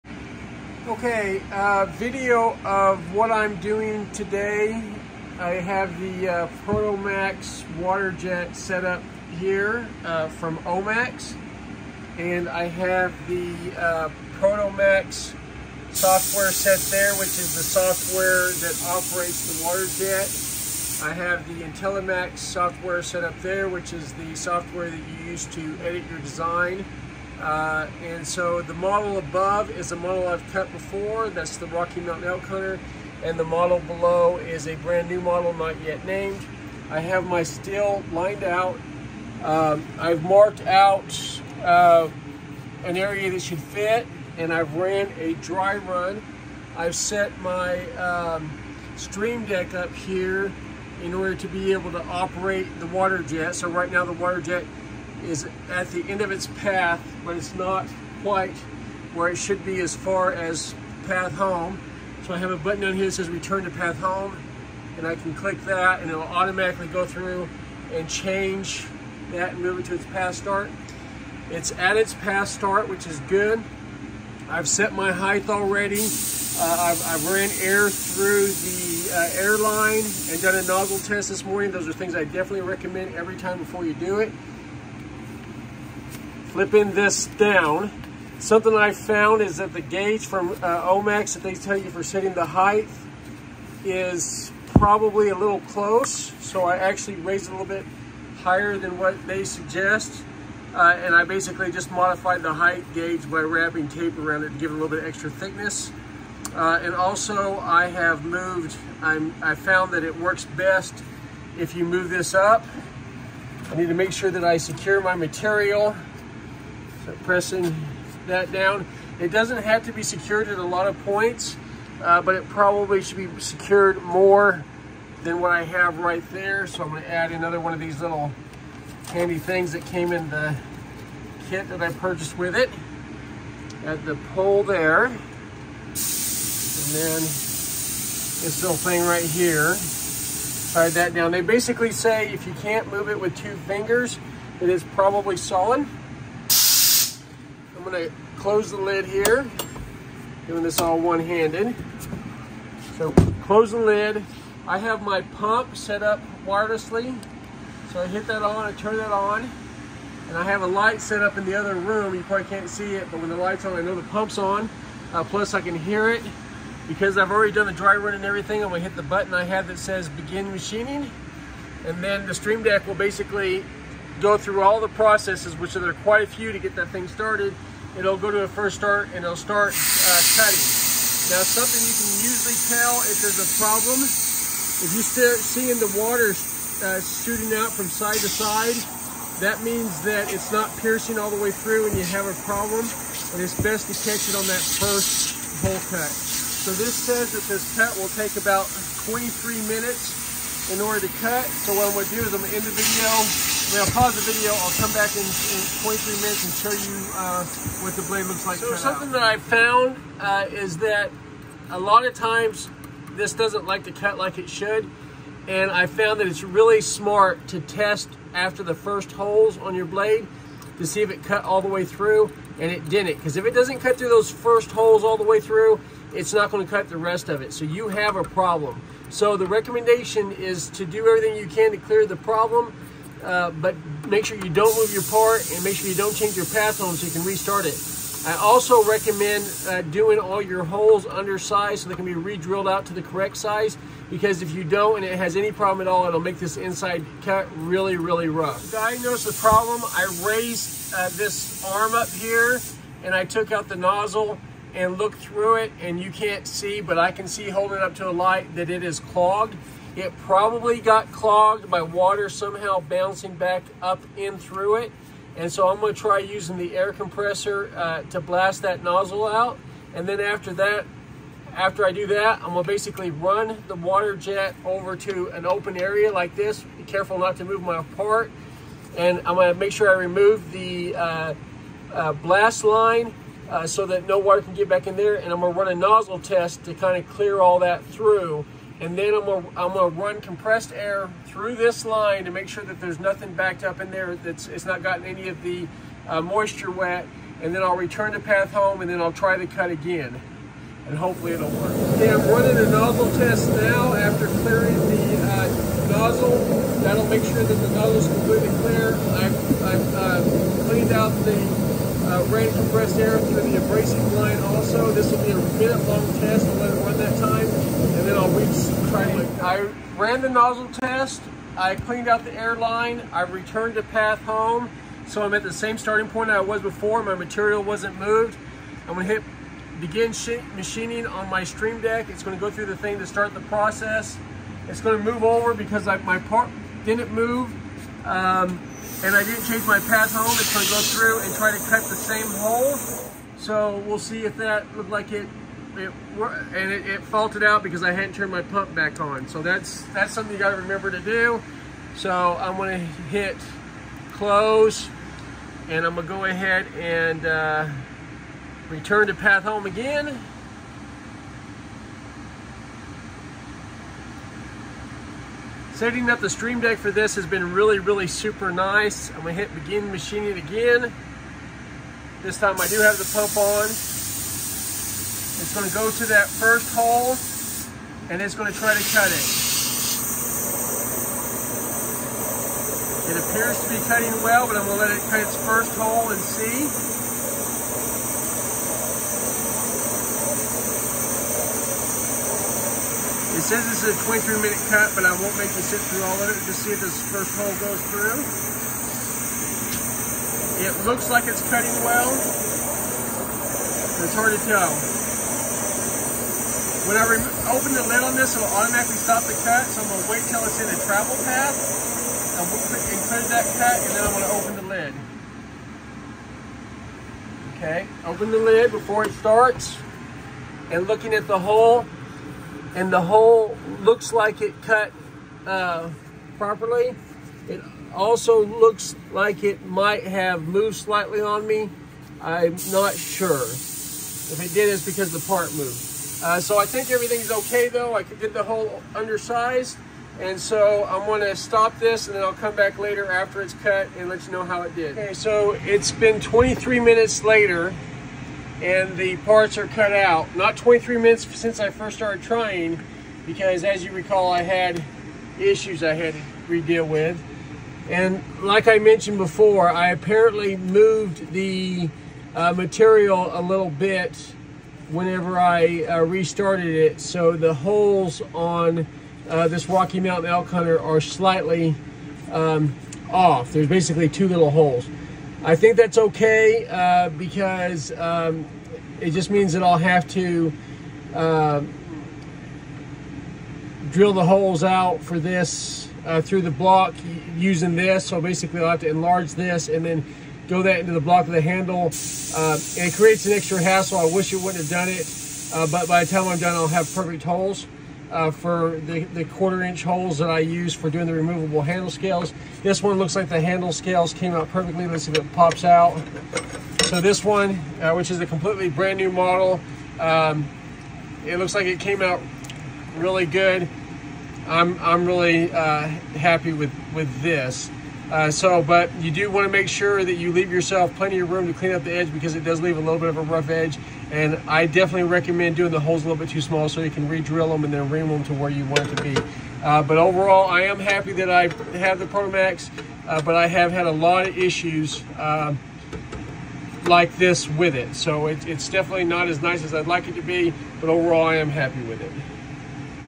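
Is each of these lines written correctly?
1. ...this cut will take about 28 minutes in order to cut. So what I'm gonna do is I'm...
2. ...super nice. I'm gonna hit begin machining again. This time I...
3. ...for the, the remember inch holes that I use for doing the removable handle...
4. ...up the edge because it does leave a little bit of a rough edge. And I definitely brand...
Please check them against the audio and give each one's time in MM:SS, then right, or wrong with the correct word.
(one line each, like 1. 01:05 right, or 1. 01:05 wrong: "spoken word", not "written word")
1. 03:17 wrong: "23", not "28"
2. 06:08 right
3. 08:18 wrong: "quarter", not "remember"
4. 08:41 wrong: "recommend", not "brand".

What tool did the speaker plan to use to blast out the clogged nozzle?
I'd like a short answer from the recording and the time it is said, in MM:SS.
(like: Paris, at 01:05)
Air compressor, at 04:26.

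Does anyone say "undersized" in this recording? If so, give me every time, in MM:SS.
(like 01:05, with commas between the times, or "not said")
04:01, 07:18.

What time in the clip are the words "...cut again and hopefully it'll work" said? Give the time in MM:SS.
04:59.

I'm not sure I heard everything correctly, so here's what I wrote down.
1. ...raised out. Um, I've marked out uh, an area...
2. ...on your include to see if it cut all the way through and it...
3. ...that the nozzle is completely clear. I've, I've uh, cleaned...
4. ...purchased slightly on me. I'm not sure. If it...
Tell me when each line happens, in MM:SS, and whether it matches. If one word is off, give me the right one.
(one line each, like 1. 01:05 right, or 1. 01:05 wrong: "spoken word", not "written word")
1. 00:38 wrong: "lined", not "raised"
2. 03:39 wrong: "blade", not "include"
3. 05:07 right
4. 07:10 wrong: "moved", not "purchased".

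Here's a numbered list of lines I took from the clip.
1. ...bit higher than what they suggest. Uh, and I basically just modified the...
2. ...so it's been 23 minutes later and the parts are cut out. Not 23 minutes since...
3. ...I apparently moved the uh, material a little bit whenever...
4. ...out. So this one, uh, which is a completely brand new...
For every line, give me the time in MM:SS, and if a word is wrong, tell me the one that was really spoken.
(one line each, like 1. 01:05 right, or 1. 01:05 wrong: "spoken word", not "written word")
1. 01:37 right
2. 07:25 right
3. 07:39 right
4. 08:25 right.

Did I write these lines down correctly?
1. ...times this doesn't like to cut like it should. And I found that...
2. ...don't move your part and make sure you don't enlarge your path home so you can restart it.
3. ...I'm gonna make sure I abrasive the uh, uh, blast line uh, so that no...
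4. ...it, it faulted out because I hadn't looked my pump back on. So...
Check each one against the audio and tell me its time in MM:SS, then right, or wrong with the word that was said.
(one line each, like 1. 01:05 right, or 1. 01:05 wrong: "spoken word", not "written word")
1. 03:32 right
2. 03:54 wrong: "change", not "enlarge"
3. 04:39 wrong: "remove", not "abrasive"
4. 05:46 wrong: "turned", not "looked".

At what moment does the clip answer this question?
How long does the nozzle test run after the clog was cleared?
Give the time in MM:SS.
05:15.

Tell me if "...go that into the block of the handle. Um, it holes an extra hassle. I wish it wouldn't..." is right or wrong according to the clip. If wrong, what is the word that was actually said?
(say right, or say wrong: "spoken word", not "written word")
wrong: "creates", not "holes".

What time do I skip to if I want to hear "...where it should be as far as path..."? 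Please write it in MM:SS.
00:59.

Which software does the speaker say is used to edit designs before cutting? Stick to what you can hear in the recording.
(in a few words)
IntelliMax.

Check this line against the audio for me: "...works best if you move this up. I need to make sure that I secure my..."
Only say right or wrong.
right.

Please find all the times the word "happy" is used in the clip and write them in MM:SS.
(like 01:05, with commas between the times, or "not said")
08:36, 08:50, 09:01.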